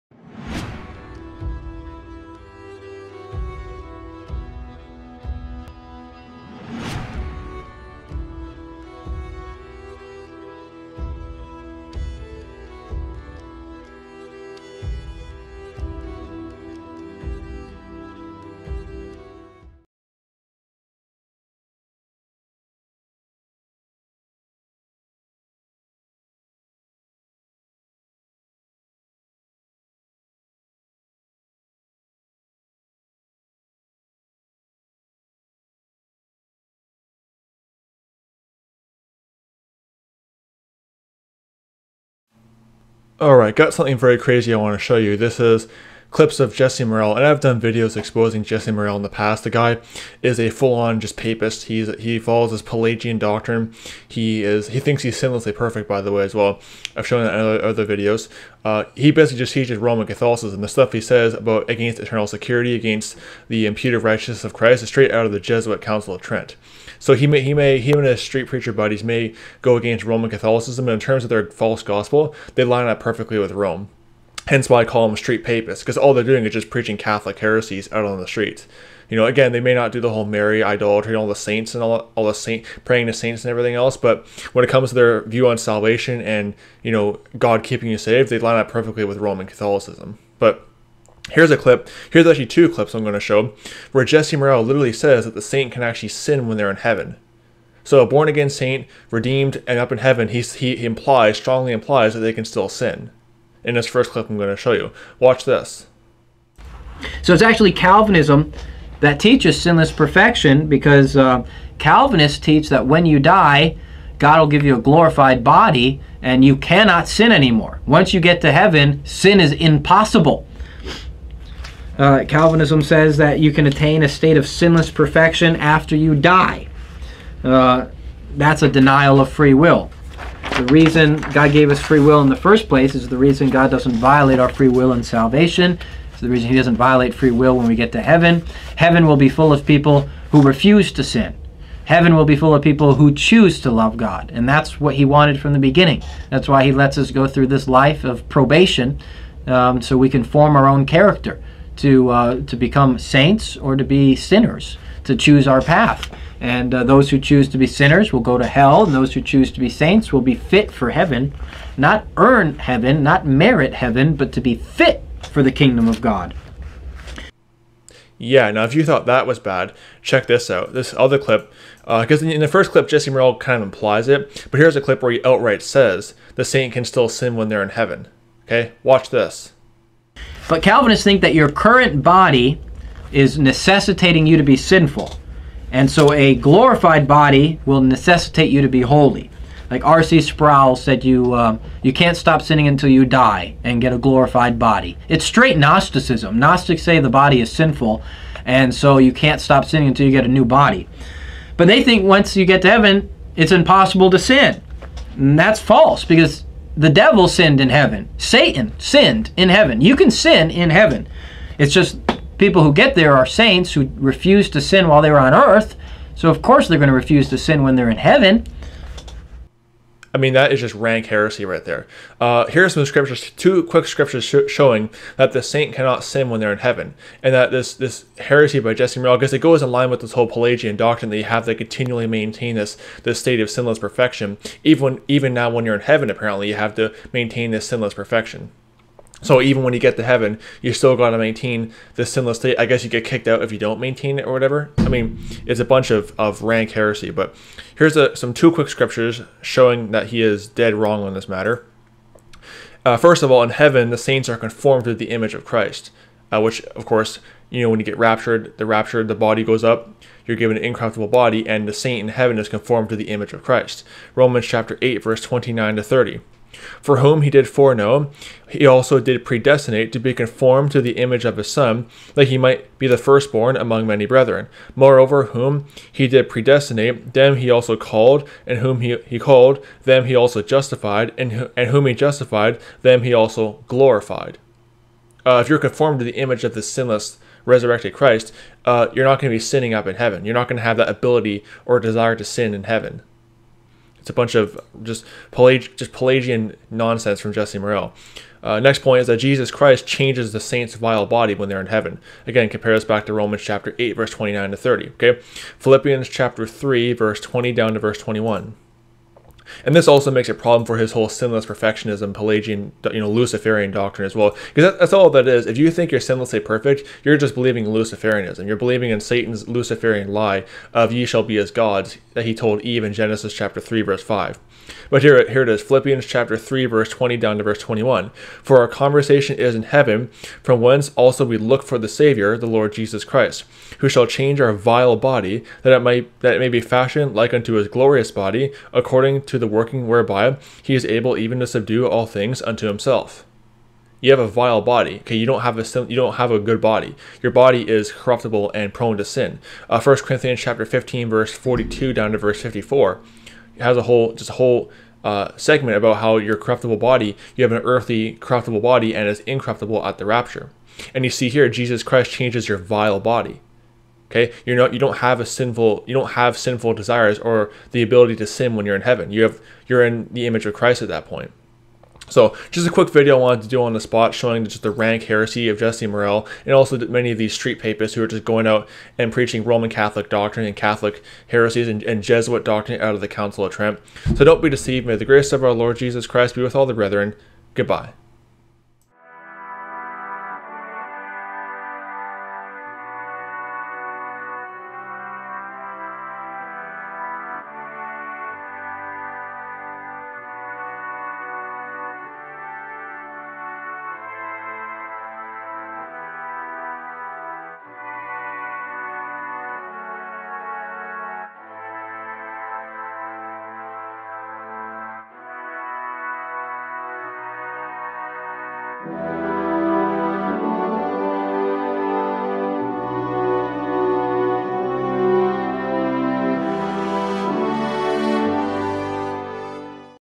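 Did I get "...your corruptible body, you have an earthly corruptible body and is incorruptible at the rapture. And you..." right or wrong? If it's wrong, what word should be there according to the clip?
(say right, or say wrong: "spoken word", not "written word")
right.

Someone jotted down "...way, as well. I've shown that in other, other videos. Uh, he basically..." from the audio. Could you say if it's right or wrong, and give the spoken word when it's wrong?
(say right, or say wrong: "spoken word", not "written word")
right.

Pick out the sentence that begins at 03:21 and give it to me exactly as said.
But they think once you get to heaven, it's impossible to sin.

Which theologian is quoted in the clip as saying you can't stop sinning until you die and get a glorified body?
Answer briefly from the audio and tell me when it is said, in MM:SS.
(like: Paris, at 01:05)
R.C. Sproul, at 03:09.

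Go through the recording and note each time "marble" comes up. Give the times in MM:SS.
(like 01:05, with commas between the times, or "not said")
not said.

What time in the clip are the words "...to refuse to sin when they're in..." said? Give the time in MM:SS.
03:36.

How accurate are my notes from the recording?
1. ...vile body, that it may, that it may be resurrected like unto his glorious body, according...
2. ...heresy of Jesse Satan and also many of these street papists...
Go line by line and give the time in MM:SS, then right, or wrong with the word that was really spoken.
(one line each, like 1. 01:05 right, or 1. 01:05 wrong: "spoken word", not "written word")
1. 05:34 wrong: "fashioned", not "resurrected"
2. 06:15 wrong: "Morrell", not "Satan".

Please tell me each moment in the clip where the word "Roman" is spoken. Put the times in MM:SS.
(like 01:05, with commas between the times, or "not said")
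00:59, 01:10, 01:29, 04:24, 05:03, 06:19.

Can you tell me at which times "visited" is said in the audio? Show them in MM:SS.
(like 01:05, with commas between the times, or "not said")
not said.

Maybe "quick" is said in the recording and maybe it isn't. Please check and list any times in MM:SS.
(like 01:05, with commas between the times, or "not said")
03:43, 04:08, 06:12.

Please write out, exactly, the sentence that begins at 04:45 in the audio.
Uh, if you're conformed to the image of the sinless, resurrected Christ, uh, you're not going to be sinning up in heaven.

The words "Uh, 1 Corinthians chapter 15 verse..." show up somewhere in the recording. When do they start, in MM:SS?
05:49.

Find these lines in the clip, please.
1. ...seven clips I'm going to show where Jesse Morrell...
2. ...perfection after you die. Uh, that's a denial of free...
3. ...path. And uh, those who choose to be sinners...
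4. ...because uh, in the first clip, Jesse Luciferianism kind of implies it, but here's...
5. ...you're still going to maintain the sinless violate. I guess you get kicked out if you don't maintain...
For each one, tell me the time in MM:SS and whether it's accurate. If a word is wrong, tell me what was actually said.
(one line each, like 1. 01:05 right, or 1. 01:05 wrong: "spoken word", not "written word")
1. 01:32 wrong: "two", not "seven"
2. 02:04 right
3. 02:35 right
4. 02:51 wrong: "Morrell", not "Luciferianism"
5. 04:00 wrong: "state", not "violate".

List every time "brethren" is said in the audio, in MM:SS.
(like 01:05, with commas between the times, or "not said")
04:34, 06:26.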